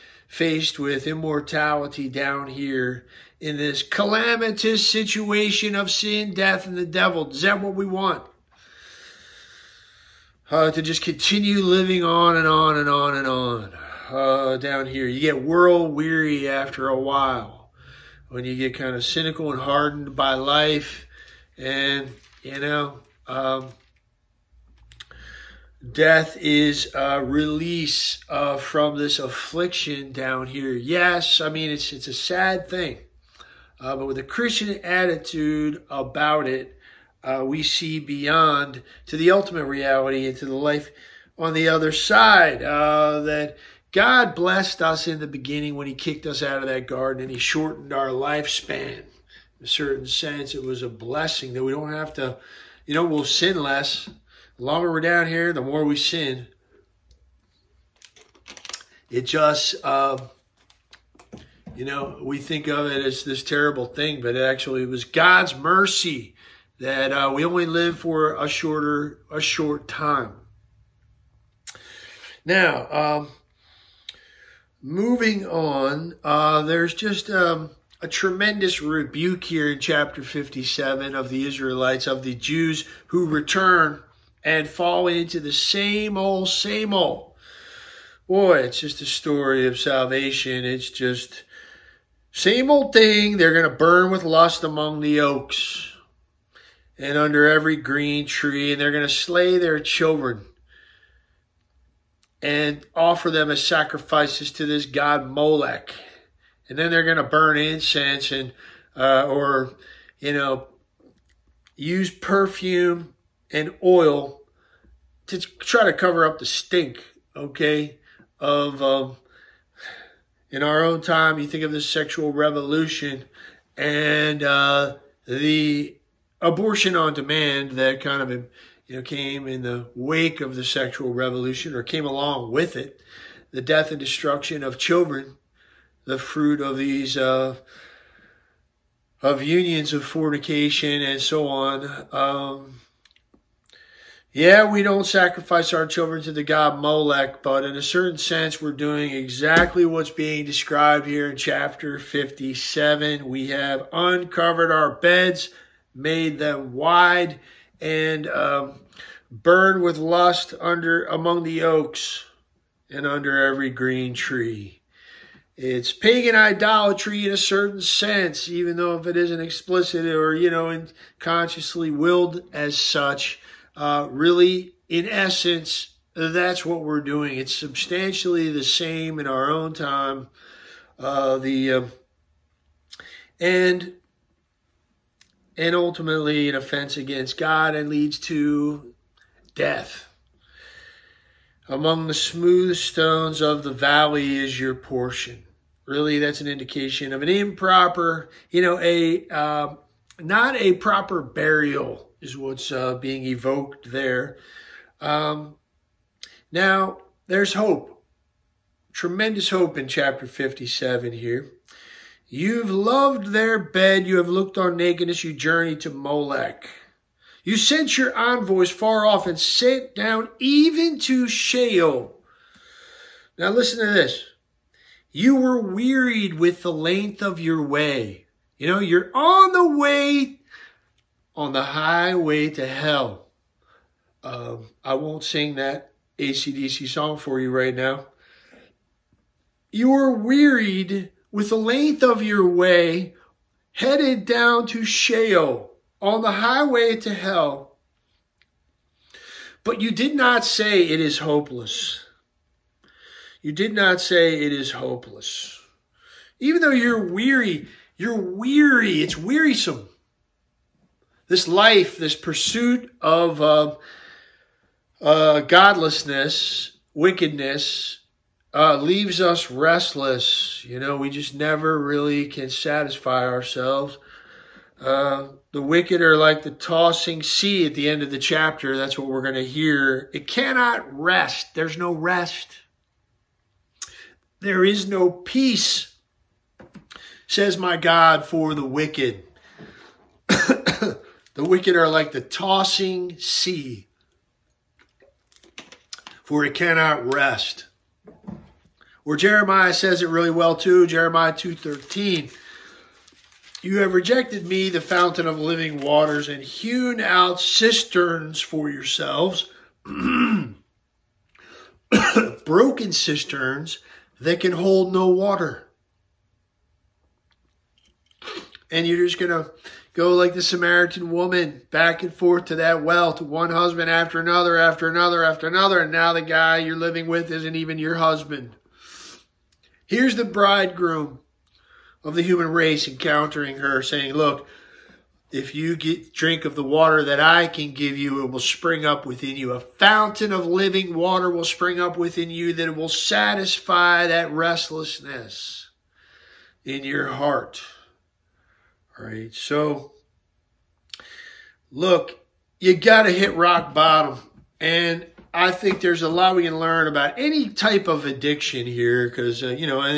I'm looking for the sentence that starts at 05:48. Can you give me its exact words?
All right, so look, you got to hit rock bottom.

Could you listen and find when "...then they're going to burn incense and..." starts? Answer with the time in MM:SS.
01:46.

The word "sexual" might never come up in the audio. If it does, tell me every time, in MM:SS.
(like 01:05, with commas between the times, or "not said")
02:01, 02:10.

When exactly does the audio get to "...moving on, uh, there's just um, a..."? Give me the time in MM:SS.
01:14.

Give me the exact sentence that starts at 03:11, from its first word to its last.
Among the smooth stones of the valley is your portion.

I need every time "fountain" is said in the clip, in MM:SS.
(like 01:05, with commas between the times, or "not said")
05:04, 05:39.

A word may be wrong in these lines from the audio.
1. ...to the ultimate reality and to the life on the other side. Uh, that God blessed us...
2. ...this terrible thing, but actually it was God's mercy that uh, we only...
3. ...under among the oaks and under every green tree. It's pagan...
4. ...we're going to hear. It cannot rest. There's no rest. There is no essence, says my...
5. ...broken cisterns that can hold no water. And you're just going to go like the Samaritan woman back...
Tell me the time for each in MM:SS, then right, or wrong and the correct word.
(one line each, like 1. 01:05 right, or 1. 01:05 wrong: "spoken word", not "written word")
1. 00:39 right
2. 01:03 right
3. 02:40 right
4. 04:39 wrong: "peace", not "essence"
5. 05:12 right.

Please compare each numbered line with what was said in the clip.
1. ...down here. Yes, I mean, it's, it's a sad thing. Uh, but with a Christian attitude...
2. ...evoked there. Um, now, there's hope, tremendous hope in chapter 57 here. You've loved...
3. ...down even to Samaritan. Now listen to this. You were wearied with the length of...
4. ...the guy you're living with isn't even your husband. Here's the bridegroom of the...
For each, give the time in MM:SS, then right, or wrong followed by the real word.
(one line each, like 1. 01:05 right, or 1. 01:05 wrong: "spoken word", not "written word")
1. 00:30 right
2. 03:23 right
3. 03:39 wrong: "Sheol", not "Samaritan"
4. 05:26 right.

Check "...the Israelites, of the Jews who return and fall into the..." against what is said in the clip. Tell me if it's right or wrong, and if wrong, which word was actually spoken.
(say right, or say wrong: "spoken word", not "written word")
right.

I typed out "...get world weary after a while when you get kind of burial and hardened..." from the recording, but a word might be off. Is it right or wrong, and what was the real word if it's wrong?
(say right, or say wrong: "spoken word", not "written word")
wrong: "cynical", not "burial".